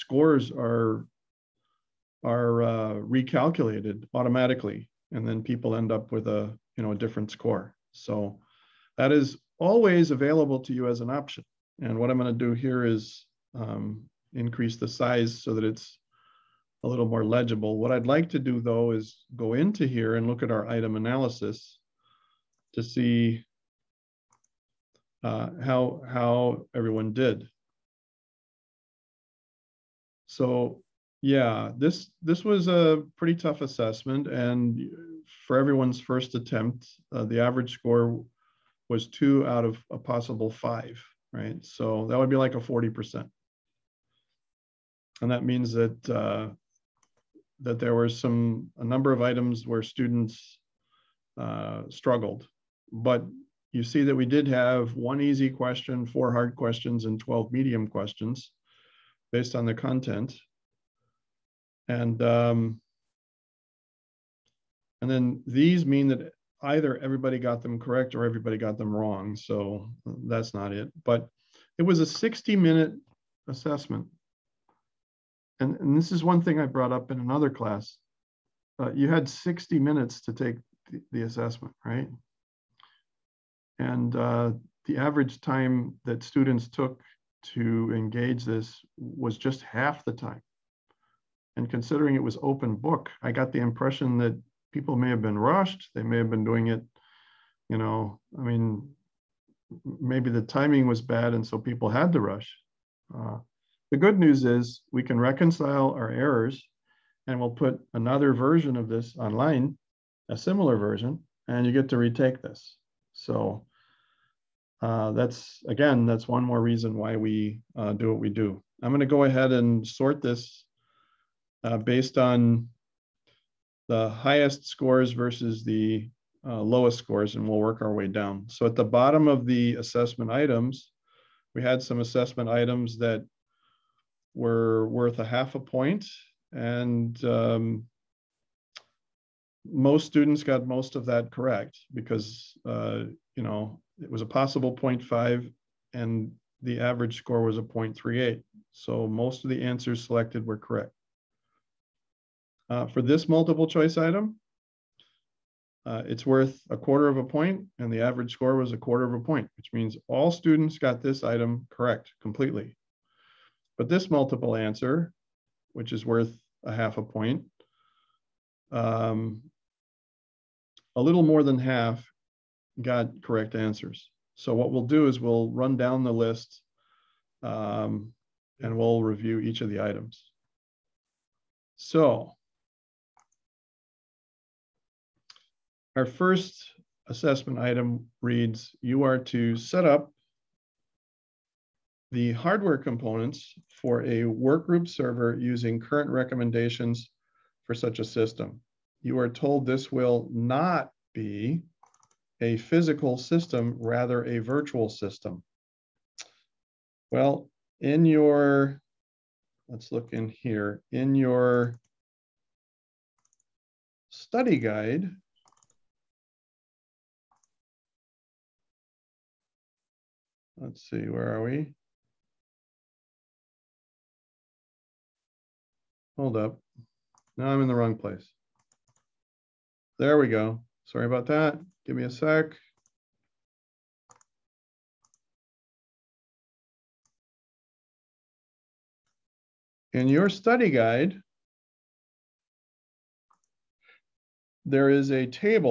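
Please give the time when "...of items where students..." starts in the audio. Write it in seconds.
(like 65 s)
49 s.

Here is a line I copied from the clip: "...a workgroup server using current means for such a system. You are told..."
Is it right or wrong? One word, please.
wrong.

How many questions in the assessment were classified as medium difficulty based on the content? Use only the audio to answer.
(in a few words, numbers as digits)
12.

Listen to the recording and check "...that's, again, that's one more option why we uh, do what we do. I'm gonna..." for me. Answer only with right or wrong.
wrong.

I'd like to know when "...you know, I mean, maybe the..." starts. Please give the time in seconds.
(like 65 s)
97 s.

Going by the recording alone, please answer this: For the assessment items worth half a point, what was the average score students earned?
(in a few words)
0.38.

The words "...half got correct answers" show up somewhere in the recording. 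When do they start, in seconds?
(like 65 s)
171 s.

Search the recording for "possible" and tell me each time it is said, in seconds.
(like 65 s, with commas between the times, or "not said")
39 s, 144 s.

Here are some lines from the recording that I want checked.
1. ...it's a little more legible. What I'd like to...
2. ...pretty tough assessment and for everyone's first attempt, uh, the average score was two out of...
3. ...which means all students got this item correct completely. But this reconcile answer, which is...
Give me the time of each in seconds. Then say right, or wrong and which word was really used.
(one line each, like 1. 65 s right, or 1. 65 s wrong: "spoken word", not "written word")
1. 15 s right
2. 33 s right
3. 159 s wrong: "multiple", not "reconcile".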